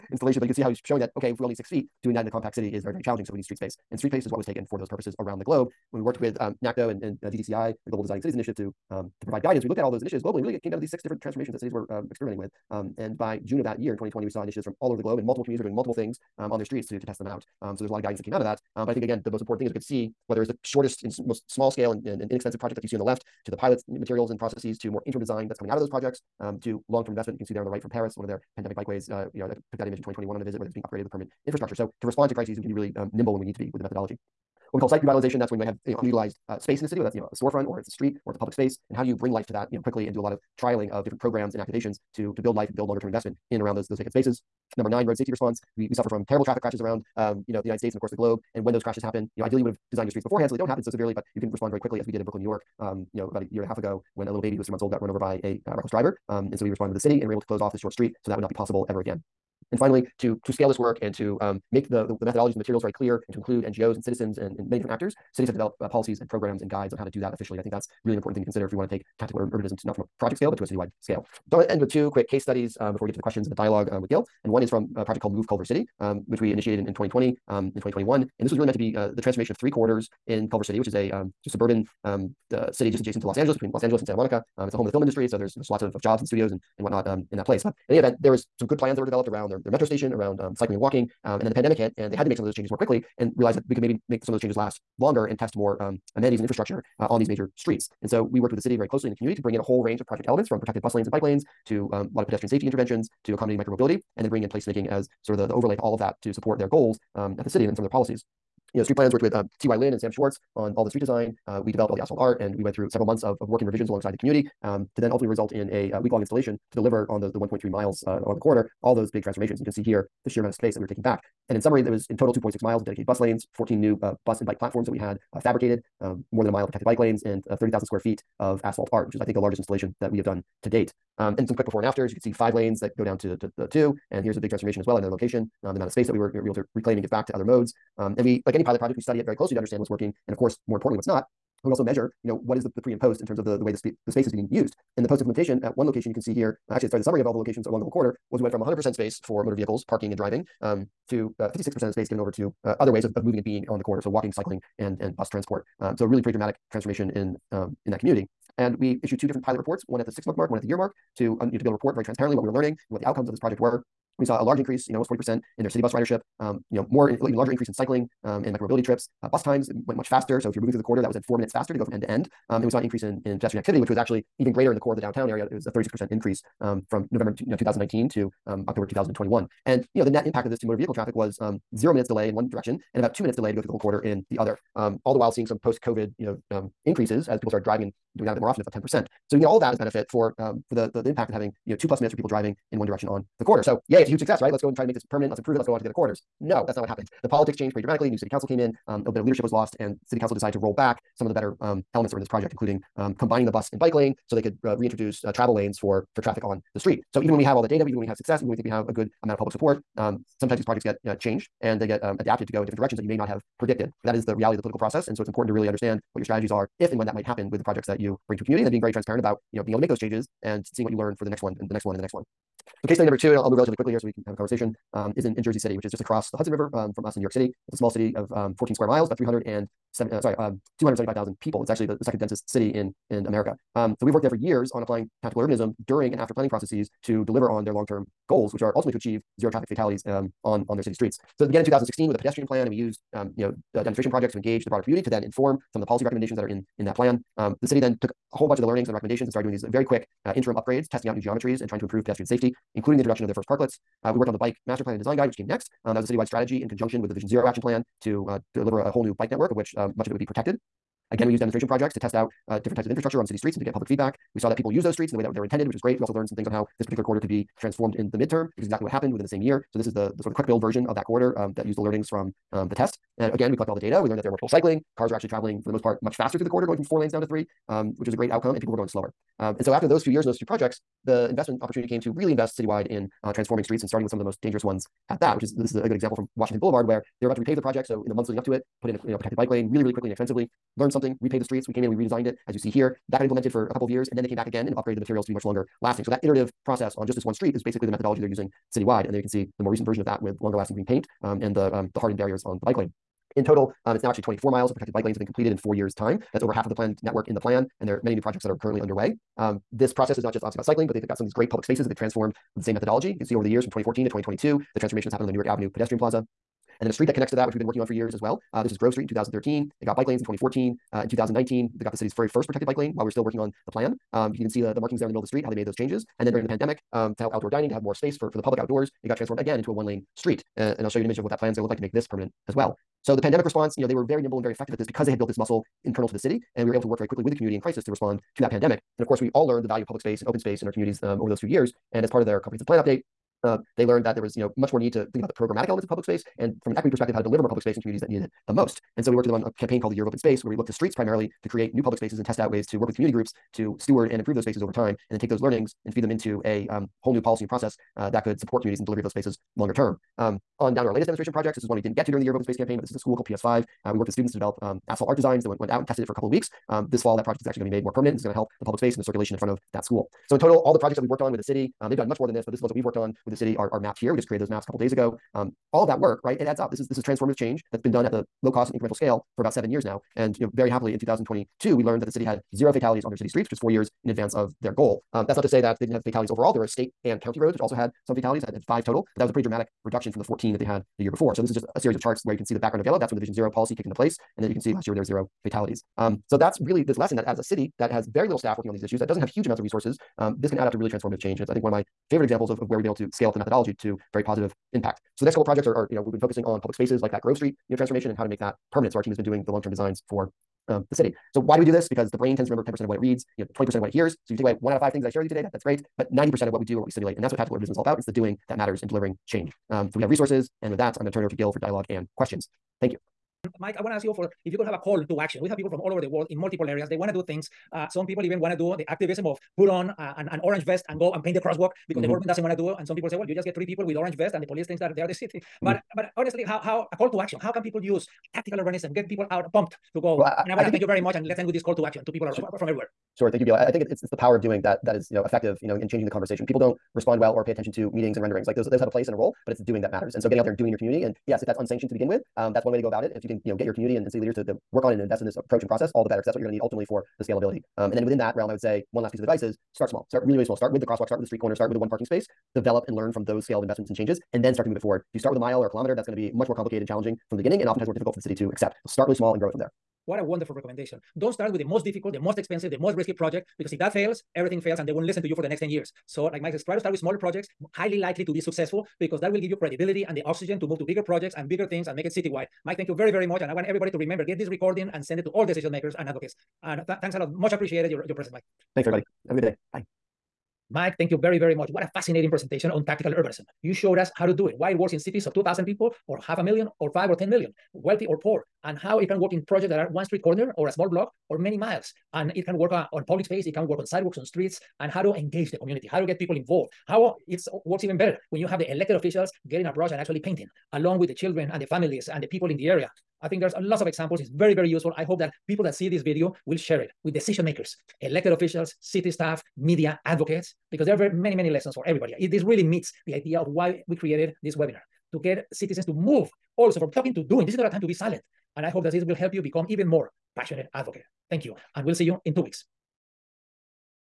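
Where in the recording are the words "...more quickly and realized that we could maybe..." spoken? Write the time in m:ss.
1:32.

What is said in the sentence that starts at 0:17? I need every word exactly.
Um, so there's a lot of guidance that came out of that.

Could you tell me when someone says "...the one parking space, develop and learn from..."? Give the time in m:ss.
7:41.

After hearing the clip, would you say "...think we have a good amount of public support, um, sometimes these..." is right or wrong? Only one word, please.
right.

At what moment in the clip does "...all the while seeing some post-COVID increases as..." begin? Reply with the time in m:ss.
3:04.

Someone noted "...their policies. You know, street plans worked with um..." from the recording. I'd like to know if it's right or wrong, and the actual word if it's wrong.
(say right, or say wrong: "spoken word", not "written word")
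right.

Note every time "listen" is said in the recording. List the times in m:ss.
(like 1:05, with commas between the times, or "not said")
7:55.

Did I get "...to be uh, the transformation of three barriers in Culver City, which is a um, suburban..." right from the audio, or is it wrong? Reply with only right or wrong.
wrong.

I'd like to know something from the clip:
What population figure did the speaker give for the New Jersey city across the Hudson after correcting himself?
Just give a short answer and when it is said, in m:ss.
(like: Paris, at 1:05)
275,000, at 3:50.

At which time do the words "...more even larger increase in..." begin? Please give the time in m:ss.
2:46.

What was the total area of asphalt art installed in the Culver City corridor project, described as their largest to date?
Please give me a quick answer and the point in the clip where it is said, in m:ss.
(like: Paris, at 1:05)
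30,000 square feet, at 2:07.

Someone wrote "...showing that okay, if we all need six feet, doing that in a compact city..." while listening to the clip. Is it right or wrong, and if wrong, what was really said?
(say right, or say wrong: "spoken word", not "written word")
right.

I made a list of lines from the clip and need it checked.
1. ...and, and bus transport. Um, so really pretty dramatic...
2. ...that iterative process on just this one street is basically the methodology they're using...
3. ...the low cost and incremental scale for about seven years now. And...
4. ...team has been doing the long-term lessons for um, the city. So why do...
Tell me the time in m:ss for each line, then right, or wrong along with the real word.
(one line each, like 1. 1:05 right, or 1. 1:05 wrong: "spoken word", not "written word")
1. 2:34 right
2. 4:56 right
3. 6:18 right
4. 6:49 wrong: "designs", not "lessons".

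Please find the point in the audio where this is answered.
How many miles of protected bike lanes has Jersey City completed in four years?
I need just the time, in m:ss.
5:04.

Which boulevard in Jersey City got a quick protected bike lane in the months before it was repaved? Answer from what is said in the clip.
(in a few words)
Washington Boulevard.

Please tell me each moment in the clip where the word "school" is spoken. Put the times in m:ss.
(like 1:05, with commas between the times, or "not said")
6:02, 6:09.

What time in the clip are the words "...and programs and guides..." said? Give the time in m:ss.
1:06.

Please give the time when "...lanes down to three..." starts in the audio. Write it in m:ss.
4:36.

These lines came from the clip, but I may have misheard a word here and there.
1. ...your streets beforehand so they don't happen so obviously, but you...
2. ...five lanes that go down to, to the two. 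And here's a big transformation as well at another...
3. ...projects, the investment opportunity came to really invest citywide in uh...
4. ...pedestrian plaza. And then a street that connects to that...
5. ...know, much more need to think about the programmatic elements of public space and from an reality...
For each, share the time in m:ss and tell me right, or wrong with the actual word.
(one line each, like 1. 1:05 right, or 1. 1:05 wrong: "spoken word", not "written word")
1. 0:50 wrong: "severely", not "obviously"
2. 2:12 right
3. 4:40 right
4. 5:15 right
5. 5:44 wrong: "equity", not "reality".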